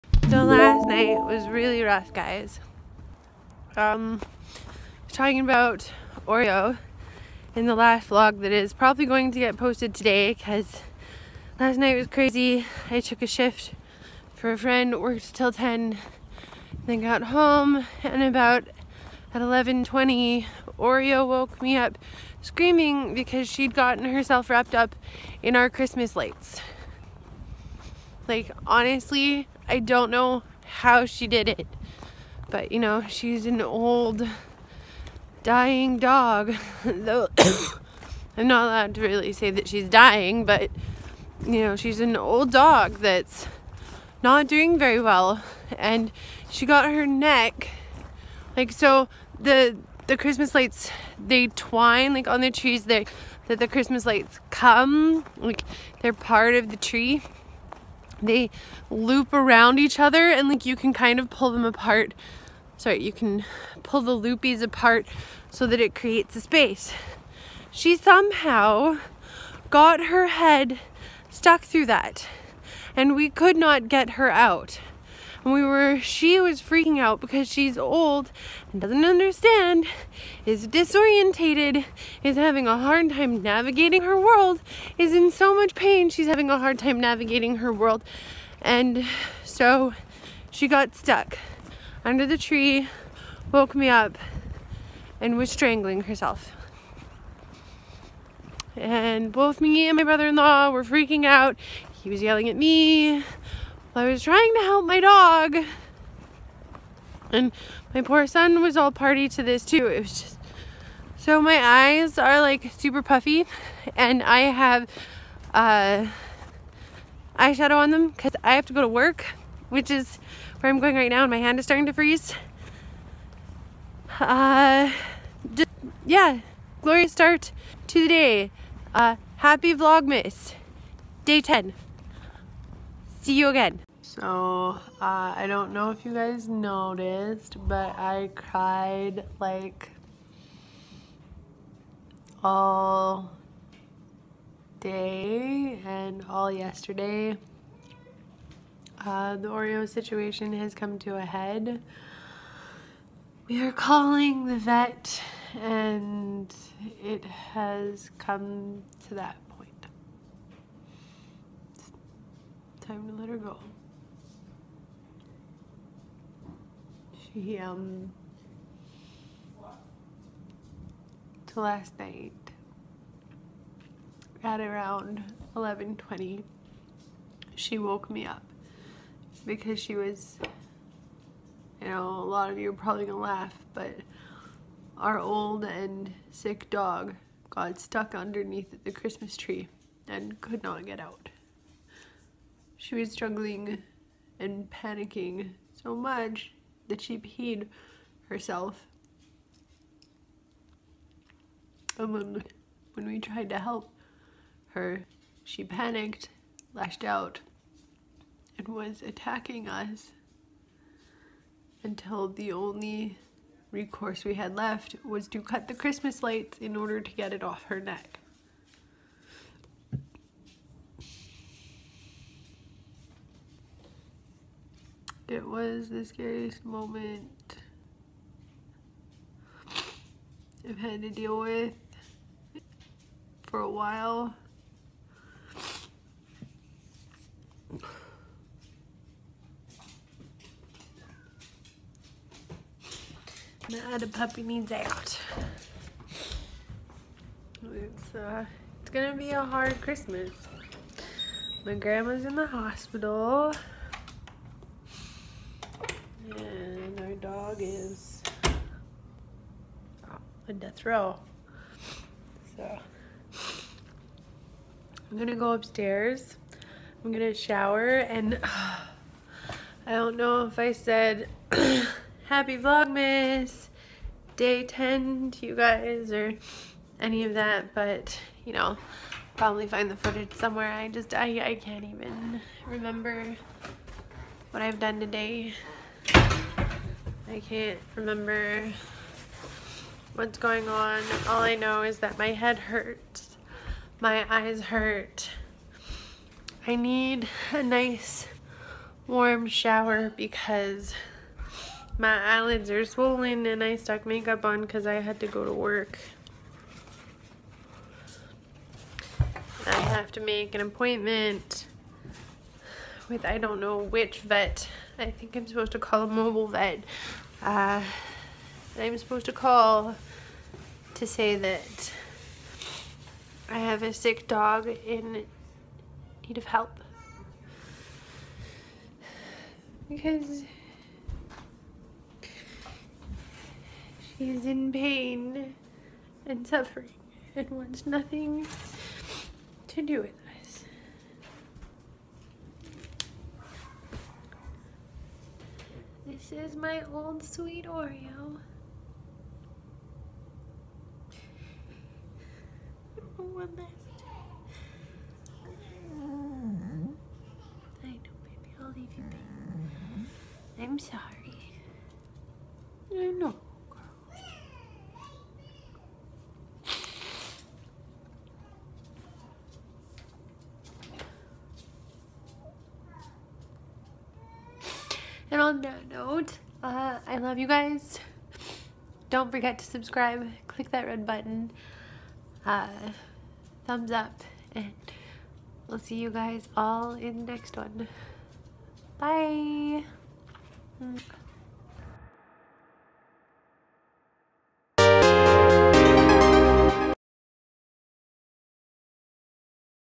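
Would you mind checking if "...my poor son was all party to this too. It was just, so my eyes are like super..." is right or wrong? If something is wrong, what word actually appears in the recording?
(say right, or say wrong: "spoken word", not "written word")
right.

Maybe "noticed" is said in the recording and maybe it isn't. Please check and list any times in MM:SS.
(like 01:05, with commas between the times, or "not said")
02:16.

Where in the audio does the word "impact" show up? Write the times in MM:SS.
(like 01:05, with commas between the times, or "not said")
not said.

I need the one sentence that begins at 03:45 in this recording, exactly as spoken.
It was the scariest moment I've had to deal with for a while.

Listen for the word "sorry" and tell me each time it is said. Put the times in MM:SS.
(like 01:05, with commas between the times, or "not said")
01:02, 06:00.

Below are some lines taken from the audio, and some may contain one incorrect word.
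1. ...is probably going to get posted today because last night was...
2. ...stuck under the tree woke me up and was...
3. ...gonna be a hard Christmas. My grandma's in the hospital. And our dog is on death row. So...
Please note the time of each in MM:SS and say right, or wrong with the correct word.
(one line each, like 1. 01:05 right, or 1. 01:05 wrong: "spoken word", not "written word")
1. 00:08 right
2. 01:30 right
3. 04:08 right.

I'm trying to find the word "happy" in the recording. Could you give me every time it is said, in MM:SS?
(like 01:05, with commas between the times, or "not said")
02:09, 04:32.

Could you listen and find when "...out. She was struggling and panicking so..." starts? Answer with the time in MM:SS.
03:10.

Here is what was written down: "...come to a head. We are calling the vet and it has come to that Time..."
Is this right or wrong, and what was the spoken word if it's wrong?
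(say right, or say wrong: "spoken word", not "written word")
right.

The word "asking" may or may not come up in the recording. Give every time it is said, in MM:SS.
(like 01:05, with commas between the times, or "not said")
not said.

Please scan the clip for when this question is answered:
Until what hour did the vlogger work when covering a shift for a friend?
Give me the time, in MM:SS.
00:15.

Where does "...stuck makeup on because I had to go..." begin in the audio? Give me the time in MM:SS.
05:03.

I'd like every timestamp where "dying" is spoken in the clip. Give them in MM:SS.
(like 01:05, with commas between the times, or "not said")
00:35, 00:39.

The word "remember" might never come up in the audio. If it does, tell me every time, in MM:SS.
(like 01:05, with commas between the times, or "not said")
04:42, 04:47.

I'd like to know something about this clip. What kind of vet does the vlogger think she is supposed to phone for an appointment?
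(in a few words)
Mobile vet.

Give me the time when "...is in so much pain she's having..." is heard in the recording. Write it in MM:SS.
01:24.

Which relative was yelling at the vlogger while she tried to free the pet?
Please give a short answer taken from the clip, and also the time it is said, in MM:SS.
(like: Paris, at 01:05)
Brother-in-law, at 01:40.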